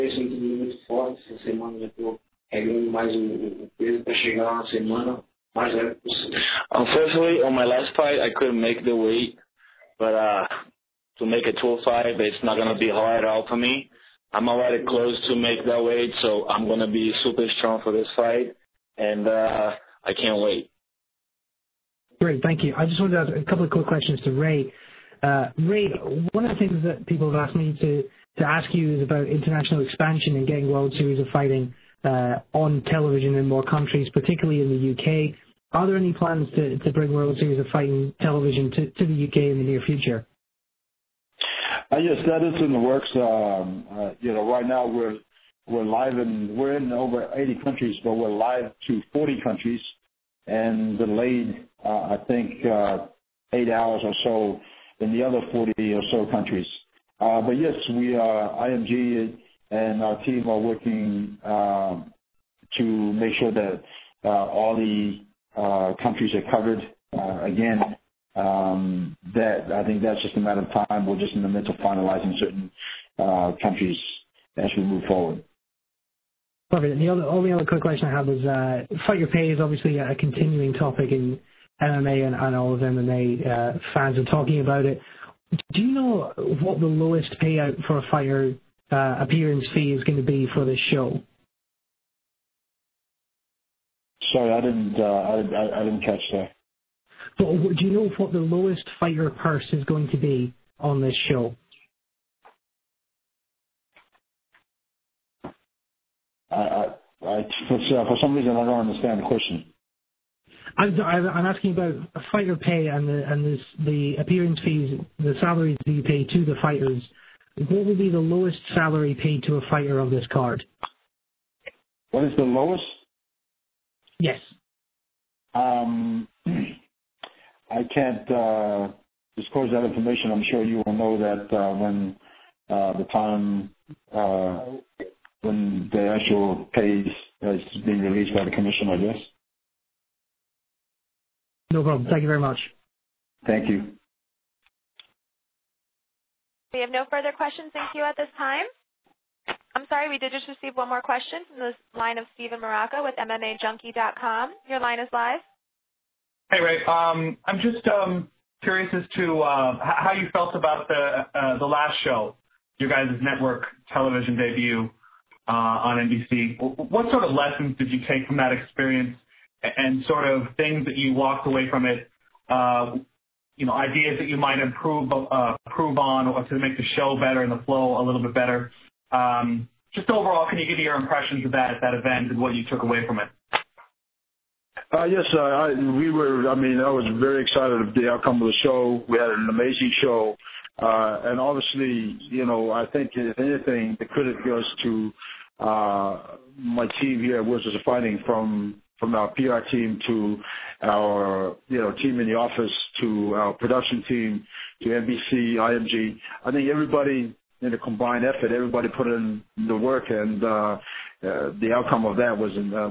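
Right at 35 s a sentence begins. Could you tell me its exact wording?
Are there any plans to, to bring World Series of Fighting television to, to the UK in the near future?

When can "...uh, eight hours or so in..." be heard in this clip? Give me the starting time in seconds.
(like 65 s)
52 s.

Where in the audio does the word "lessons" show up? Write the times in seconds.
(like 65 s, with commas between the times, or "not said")
167 s.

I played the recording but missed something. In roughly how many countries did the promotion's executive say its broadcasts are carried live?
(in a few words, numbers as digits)
40.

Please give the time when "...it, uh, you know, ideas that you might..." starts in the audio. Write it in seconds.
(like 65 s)
171 s.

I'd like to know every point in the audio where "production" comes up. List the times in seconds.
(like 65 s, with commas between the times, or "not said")
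203 s.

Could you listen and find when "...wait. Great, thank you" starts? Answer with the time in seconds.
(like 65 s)
20 s.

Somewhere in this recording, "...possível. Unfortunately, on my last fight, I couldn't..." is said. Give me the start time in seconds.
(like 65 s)
5 s.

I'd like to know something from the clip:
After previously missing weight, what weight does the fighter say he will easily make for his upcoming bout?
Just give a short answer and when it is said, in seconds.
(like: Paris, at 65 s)
205, at 11 s.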